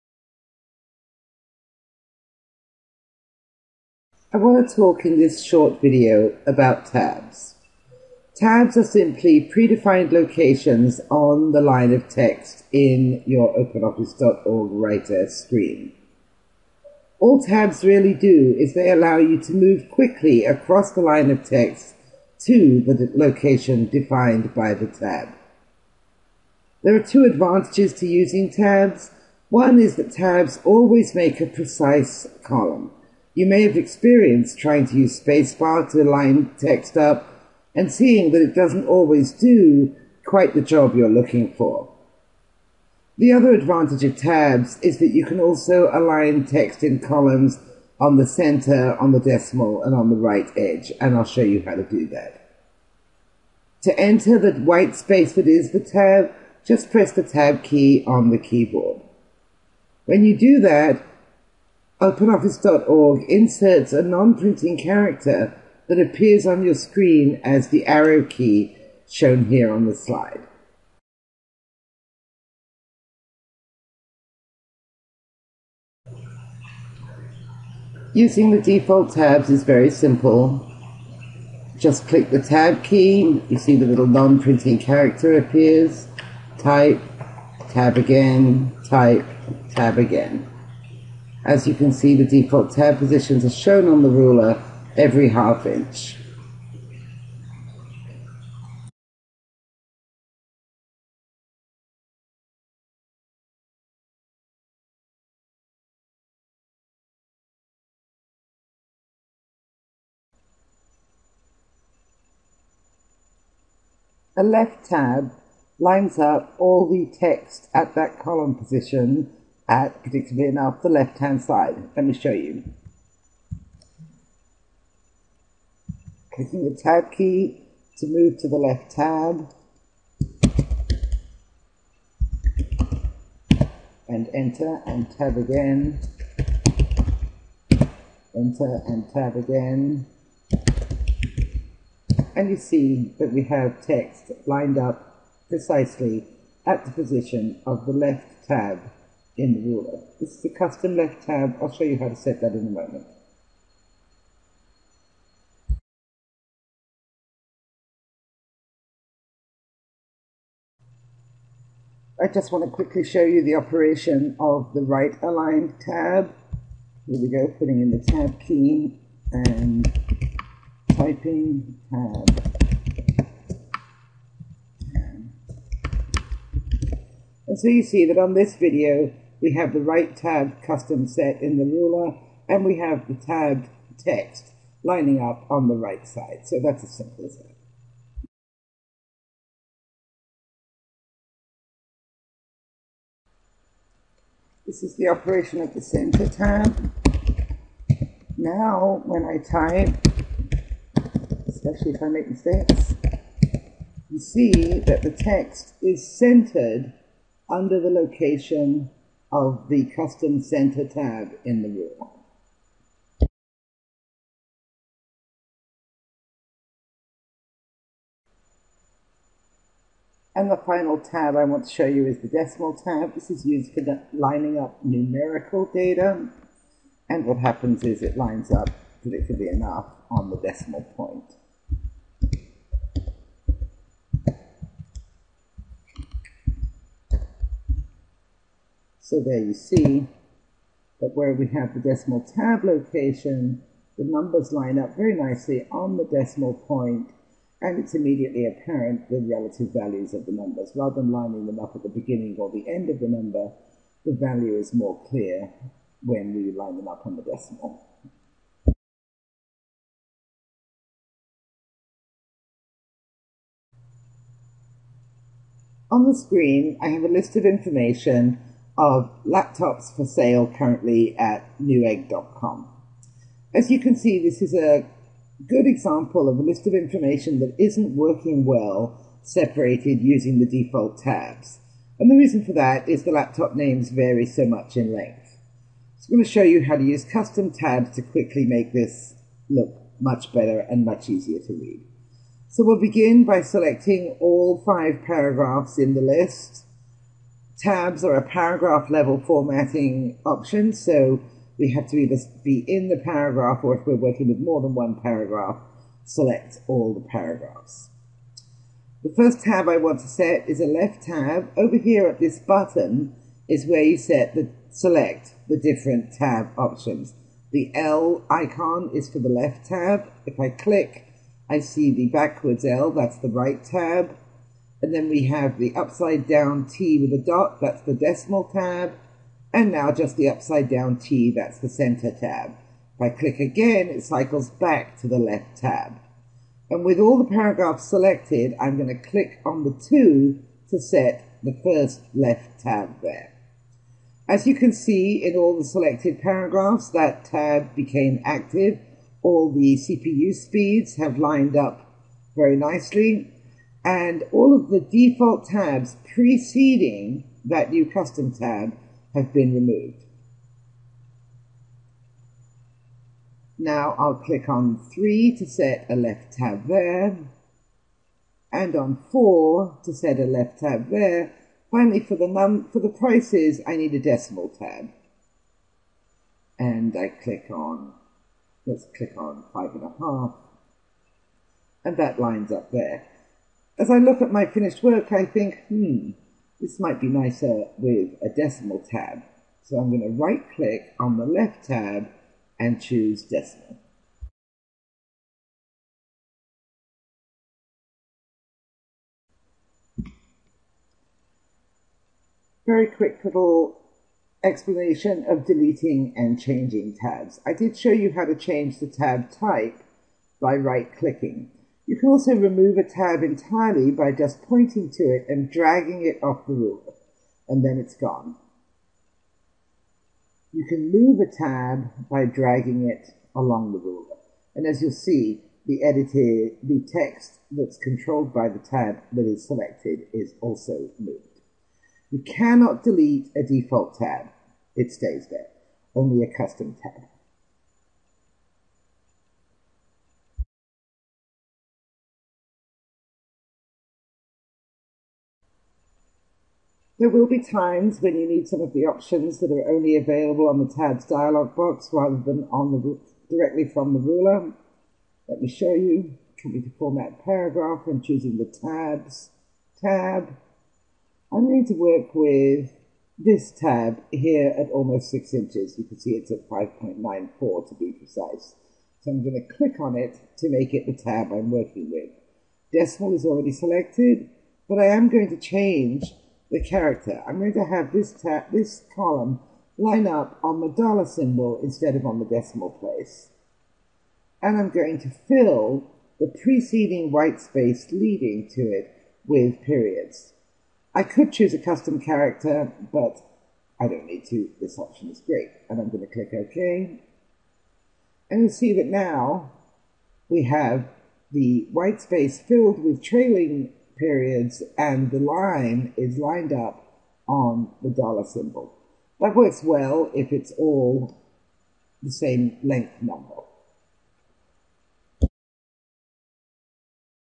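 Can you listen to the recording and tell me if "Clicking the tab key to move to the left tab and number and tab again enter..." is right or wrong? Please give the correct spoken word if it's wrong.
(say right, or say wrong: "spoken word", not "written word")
wrong: "enter", not "number".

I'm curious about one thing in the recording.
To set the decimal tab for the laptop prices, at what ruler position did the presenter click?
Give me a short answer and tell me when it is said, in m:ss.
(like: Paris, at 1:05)
5.5, at 6:19.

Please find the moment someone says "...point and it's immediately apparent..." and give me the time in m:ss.
4:06.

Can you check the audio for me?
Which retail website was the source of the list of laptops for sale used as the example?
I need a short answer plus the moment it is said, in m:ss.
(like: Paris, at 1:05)
newegg.com, at 4:31.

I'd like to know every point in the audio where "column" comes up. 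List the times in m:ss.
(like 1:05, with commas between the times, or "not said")
0:32, 0:46, 1:58, 7:58.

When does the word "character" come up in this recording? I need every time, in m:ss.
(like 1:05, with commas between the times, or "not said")
1:04, 1:24, 7:56, 8:12.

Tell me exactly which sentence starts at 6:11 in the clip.
Finally, for the, num for the prices, I need a decimal tab.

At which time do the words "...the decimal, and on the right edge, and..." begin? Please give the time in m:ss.
0:49.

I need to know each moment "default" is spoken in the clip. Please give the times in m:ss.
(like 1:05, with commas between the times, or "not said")
1:18, 1:32, 4:40, 5:54, 7:13.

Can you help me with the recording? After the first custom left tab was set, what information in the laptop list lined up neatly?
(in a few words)
CPU speeds.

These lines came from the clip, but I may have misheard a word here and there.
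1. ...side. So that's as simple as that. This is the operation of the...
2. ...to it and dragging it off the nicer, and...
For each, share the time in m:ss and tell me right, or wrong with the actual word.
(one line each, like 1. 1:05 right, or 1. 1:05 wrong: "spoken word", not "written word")
1. 3:06 right
2. 6:54 wrong: "ruler", not "nicer".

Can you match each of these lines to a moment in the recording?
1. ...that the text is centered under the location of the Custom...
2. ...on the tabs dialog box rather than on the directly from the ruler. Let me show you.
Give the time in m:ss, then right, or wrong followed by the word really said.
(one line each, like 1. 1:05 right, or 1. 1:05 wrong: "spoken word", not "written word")
1. 3:24 right
2. 7:30 right.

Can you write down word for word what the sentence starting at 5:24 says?
And then we have the upside down T with a dot, that's the decimal tab.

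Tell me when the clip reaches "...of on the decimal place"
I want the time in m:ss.
8:01.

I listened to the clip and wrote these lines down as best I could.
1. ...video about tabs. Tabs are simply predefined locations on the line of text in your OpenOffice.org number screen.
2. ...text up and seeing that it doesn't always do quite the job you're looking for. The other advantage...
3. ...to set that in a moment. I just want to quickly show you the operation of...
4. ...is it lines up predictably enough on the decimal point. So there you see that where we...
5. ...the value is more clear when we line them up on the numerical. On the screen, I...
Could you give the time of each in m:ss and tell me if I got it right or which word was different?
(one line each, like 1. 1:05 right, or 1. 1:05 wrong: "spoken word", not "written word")
1. 0:05 wrong: "writer", not "number"
2. 0:36 right
3. 2:32 right
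4. 3:47 right
5. 4:14 wrong: "decimal", not "numerical".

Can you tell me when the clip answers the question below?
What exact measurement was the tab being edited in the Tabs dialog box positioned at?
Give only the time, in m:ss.
7:46.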